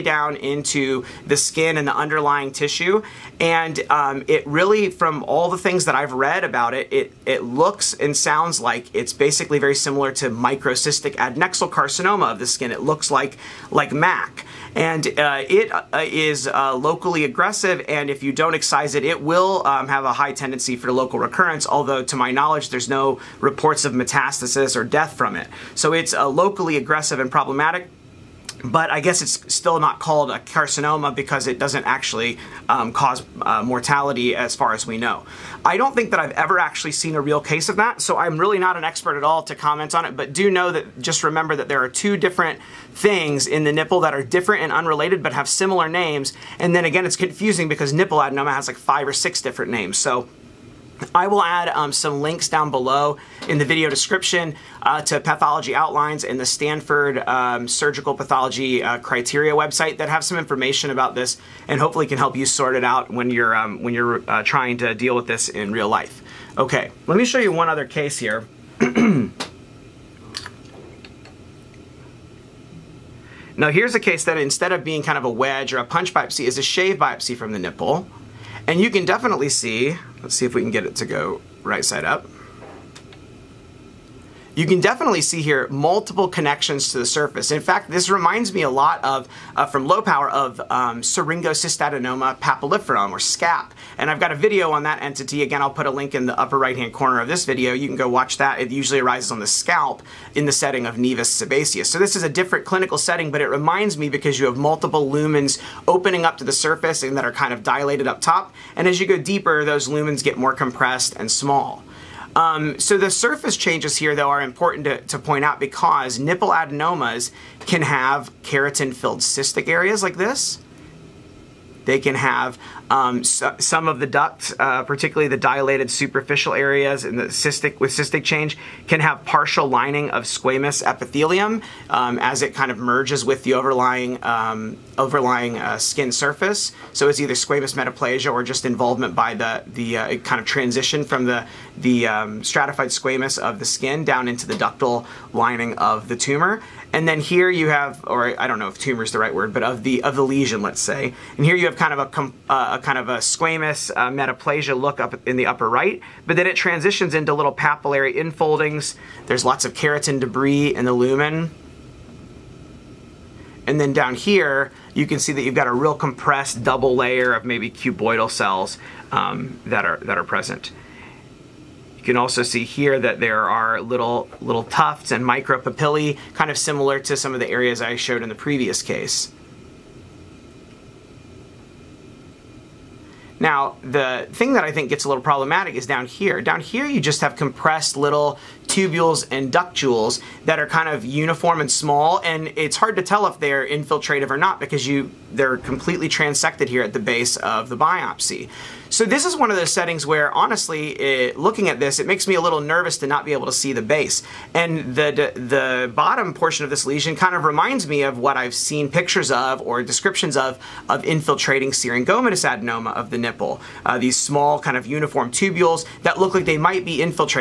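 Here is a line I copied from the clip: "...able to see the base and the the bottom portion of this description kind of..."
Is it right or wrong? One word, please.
wrong.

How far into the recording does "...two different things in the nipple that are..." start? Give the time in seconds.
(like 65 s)
41 s.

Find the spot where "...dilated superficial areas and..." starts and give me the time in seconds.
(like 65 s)
125 s.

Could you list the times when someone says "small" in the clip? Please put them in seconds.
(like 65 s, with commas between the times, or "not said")
111 s, 191 s, 214 s.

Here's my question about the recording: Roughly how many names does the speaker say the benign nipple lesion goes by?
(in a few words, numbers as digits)
5 or 6.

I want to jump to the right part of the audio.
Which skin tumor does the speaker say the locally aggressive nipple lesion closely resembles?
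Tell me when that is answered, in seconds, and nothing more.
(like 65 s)
10 s.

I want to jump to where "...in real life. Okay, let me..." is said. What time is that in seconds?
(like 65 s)
65 s.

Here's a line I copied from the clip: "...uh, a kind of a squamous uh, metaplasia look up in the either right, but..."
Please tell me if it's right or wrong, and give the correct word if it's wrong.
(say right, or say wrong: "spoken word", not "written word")
wrong: "upper", not "either".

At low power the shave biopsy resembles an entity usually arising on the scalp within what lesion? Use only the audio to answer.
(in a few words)
nevus sebaceous.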